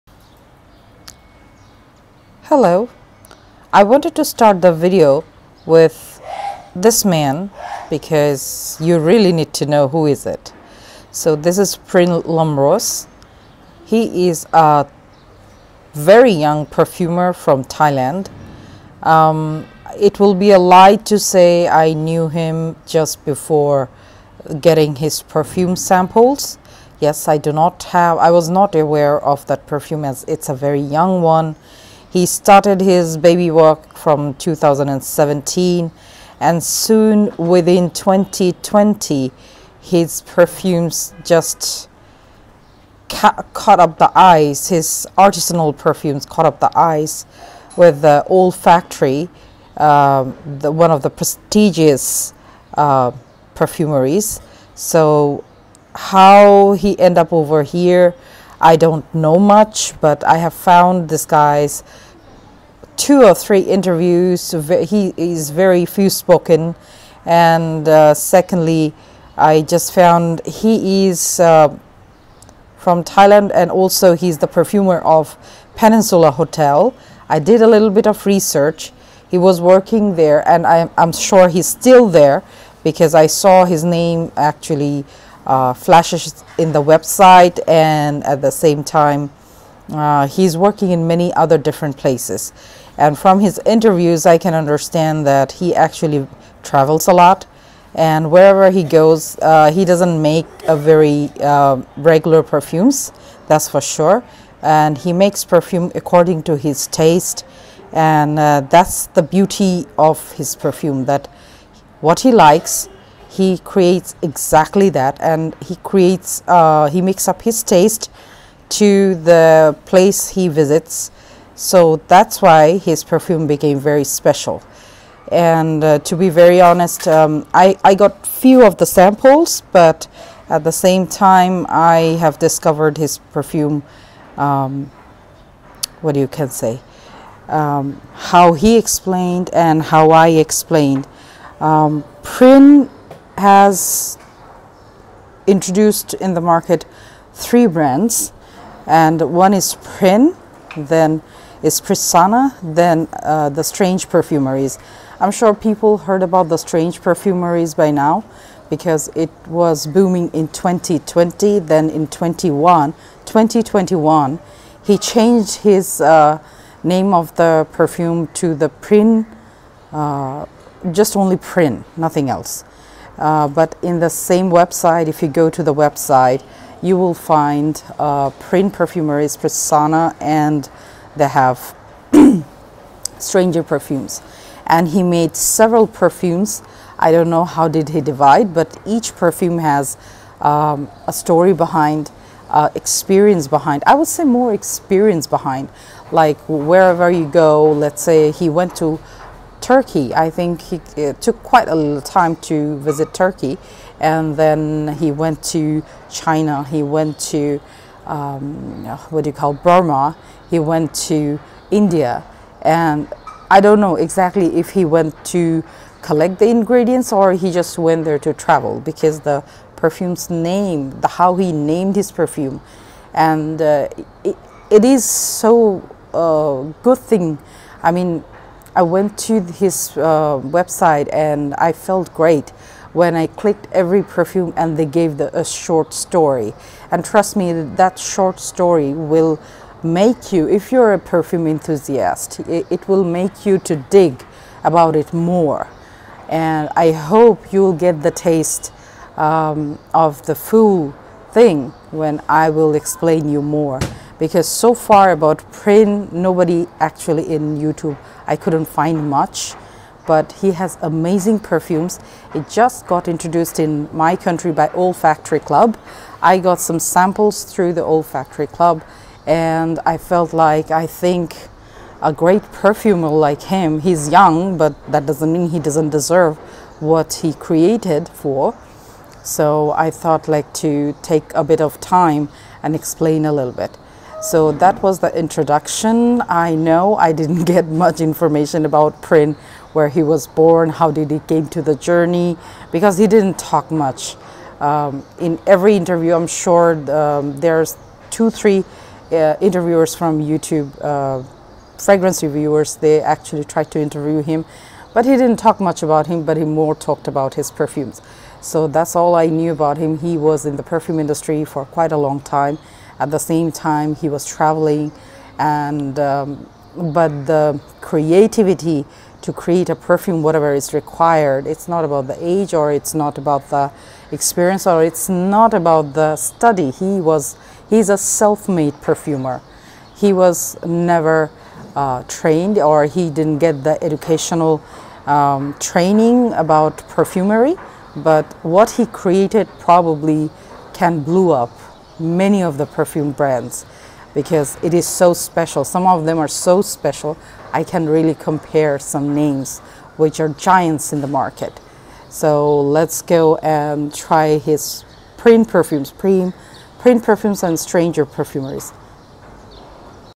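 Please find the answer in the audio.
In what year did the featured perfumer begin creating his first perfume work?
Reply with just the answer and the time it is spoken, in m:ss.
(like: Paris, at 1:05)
2017, at 0:34.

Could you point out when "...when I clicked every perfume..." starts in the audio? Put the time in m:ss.
3:52.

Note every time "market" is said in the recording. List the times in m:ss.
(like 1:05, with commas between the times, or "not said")
2:26, 5:51.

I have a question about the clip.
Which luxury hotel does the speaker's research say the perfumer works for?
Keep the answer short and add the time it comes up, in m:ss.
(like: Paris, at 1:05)
Peninsula Hotel, at 1:15.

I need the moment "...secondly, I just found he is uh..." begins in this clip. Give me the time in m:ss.
1:08.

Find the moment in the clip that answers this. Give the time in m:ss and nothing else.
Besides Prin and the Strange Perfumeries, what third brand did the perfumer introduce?
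2:31.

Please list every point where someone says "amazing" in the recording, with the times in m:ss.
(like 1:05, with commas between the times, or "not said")
4:20.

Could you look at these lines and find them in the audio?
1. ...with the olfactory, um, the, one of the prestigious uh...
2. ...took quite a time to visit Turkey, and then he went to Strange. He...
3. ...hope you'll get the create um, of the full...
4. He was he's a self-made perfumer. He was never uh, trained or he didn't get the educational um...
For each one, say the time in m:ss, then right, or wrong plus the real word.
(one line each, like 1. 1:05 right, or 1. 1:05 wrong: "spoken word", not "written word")
1. 0:47 right
2. 3:21 wrong: "China", not "Strange"
3. 4:06 wrong: "taste", not "create"
4. 5:26 right.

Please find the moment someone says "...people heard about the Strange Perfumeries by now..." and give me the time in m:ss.
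2:35.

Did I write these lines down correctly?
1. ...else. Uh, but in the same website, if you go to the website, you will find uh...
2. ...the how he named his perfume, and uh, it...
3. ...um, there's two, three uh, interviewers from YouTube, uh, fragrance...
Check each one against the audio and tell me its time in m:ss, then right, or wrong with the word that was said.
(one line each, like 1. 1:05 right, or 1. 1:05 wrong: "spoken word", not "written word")
1. 2:52 right
2. 3:41 right
3. 4:56 right.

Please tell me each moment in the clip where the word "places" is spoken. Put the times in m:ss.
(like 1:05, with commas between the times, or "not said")
1:31, 1:59.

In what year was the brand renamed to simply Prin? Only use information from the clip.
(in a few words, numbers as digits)
2021.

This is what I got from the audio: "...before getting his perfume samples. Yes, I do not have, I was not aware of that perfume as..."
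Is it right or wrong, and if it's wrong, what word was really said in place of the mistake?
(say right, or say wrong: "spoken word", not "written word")
right.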